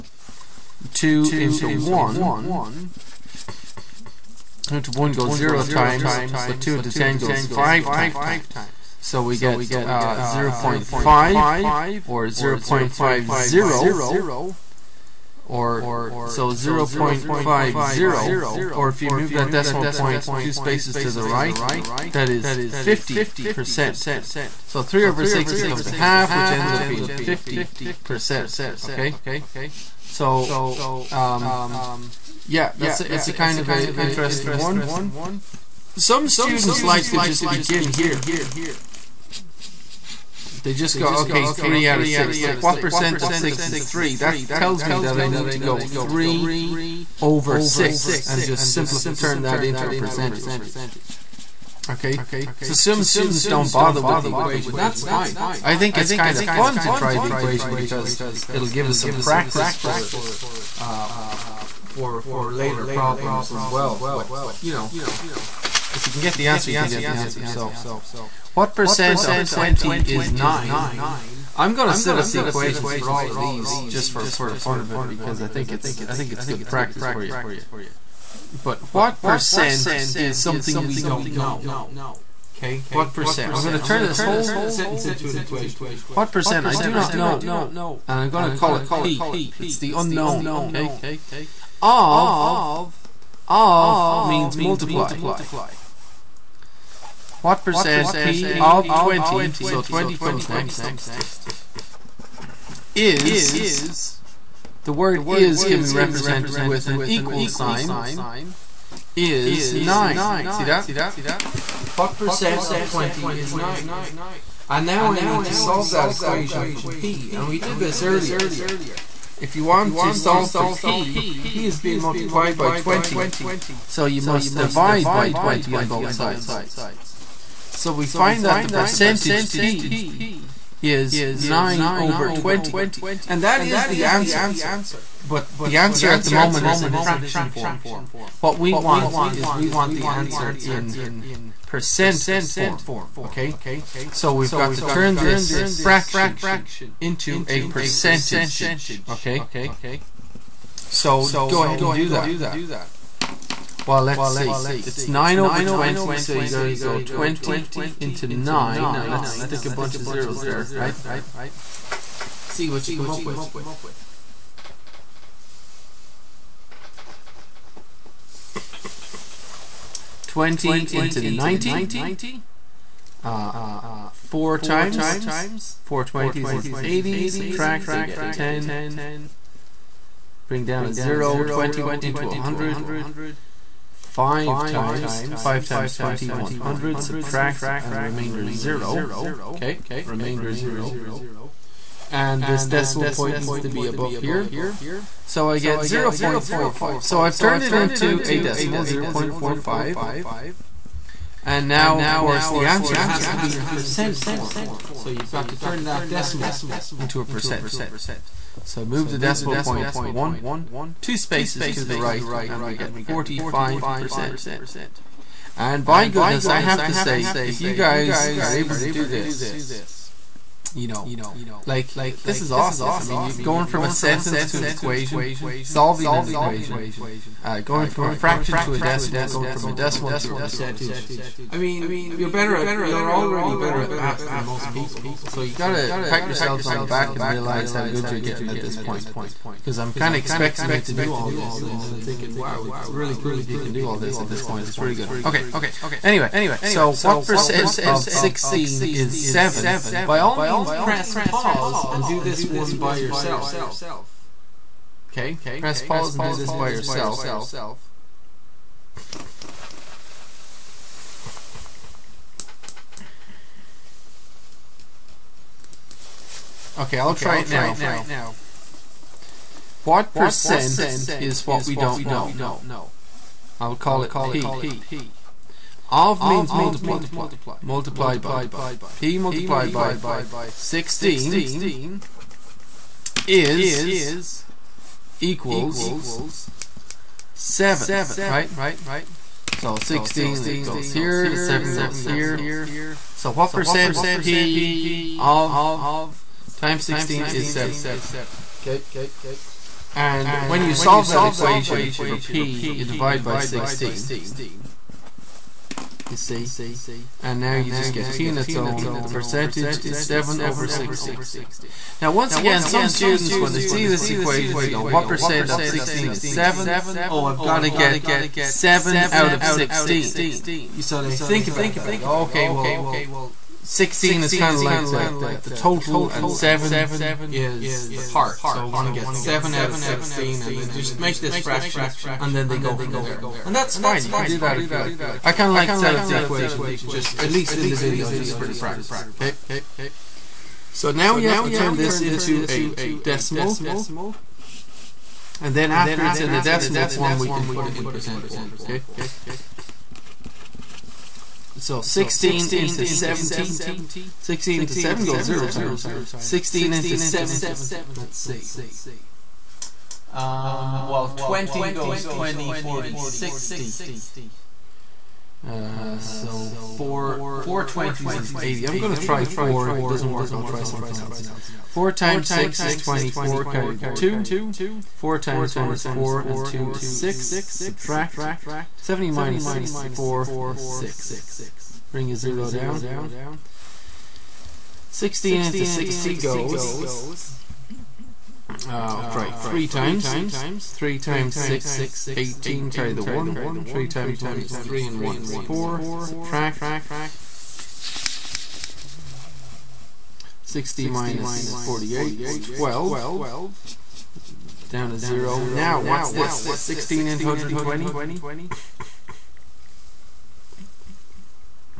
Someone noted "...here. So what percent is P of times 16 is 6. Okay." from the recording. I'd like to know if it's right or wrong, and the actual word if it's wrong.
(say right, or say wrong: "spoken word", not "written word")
wrong: "7", not "6".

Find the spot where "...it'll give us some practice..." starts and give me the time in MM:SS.
00:58.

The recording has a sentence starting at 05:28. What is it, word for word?
So I want to get 7 out of 16 and they just make this fraction and then they go from there.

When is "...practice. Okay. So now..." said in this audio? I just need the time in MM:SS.
05:38.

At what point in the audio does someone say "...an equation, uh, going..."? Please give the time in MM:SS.
03:46.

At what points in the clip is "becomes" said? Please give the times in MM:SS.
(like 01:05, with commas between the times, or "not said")
00:25.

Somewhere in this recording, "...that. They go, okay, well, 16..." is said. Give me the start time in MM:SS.
05:21.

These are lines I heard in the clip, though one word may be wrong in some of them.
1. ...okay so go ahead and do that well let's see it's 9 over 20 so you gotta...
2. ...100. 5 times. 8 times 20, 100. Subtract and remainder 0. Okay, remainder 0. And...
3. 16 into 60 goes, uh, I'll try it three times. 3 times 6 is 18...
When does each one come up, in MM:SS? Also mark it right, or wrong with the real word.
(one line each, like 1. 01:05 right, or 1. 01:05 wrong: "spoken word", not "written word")
1. 02:29 right
2. 03:02 wrong: "5", not "8"
3. 06:24 right.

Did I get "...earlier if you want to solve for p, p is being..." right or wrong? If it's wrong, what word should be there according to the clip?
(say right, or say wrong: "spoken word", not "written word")
right.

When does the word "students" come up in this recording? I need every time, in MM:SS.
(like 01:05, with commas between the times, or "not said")
00:36, 00:53, 05:12.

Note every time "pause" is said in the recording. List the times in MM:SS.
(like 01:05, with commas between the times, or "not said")
04:11, 04:15.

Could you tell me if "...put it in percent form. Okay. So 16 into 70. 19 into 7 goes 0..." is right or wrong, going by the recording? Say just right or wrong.
wrong.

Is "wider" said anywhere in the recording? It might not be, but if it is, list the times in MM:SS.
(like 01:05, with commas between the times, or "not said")
not said.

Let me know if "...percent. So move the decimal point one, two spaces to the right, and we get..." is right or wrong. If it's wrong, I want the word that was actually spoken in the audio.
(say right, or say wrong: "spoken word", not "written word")
right.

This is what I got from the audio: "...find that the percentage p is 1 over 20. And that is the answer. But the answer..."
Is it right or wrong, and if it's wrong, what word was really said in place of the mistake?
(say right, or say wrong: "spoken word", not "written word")
wrong: "9", not "1".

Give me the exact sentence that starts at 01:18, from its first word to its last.
But what percent is something we don't know?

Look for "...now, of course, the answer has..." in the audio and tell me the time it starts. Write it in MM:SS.
03:21.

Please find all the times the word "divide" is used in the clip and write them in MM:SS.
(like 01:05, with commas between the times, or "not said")
02:04, 05:02.